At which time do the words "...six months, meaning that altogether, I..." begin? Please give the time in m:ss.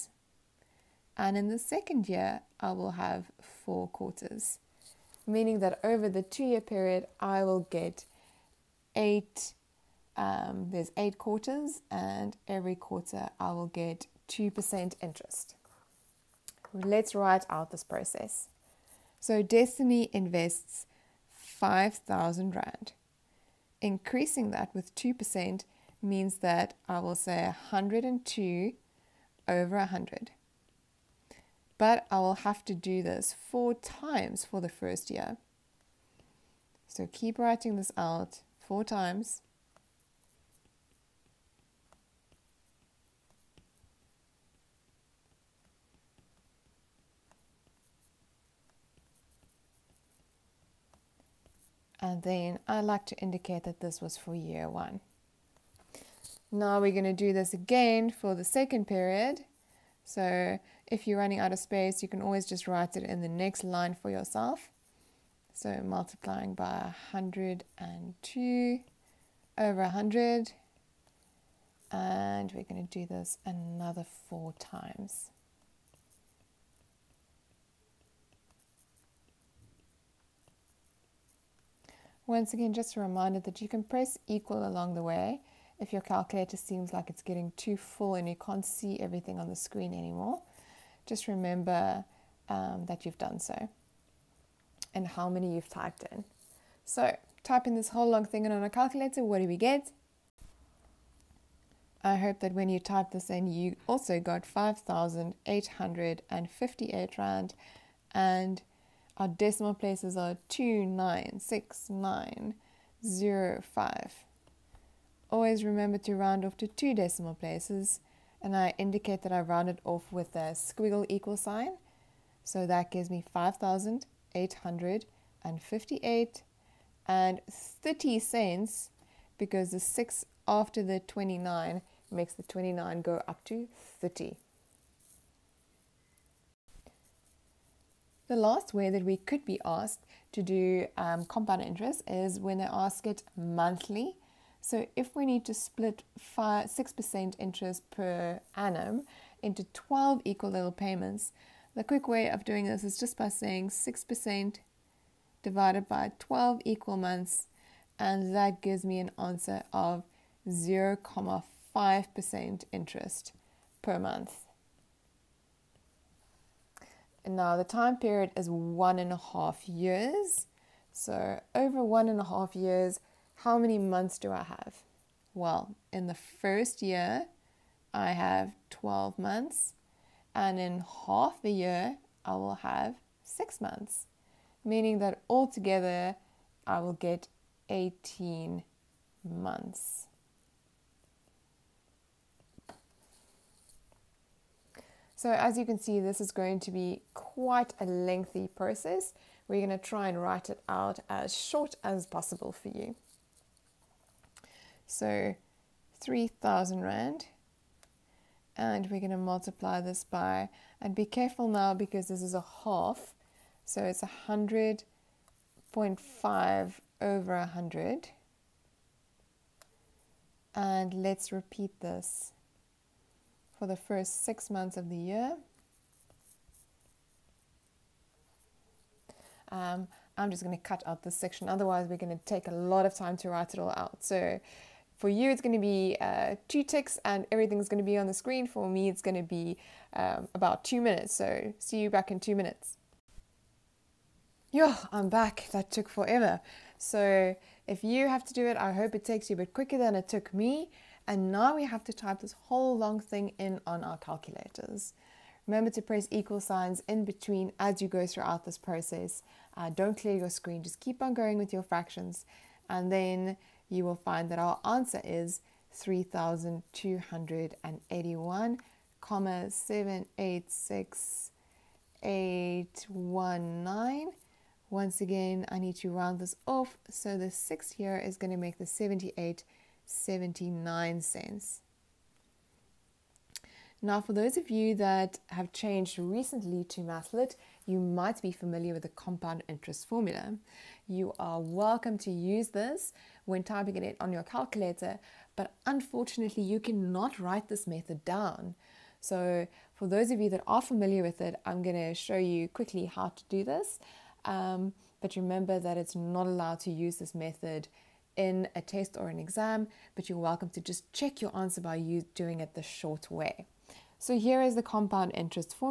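3:03.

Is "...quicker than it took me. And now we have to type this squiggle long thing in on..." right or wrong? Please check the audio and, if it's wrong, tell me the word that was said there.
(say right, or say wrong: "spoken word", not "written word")
wrong: "whole", not "squiggle".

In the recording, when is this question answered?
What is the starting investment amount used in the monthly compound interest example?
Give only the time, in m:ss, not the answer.
3:25.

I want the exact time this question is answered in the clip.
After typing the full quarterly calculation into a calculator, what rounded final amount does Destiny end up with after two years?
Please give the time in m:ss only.
2:03.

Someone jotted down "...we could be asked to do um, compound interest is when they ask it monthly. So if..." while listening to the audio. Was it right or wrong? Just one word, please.
right.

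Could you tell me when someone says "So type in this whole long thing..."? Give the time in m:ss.
1:36.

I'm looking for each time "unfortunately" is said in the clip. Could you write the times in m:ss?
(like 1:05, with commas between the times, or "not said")
4:55.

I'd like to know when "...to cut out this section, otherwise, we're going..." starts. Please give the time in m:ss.
3:50.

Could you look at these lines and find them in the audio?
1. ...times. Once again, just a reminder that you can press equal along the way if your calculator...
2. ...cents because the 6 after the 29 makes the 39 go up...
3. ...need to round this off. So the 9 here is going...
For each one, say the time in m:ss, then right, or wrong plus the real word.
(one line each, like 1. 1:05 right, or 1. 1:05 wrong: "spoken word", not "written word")
1. 1:14 right
2. 2:08 wrong: "29", not "39"
3. 4:35 wrong: "6", not "9".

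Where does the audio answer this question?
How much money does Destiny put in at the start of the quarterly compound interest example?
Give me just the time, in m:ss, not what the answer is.
0:21.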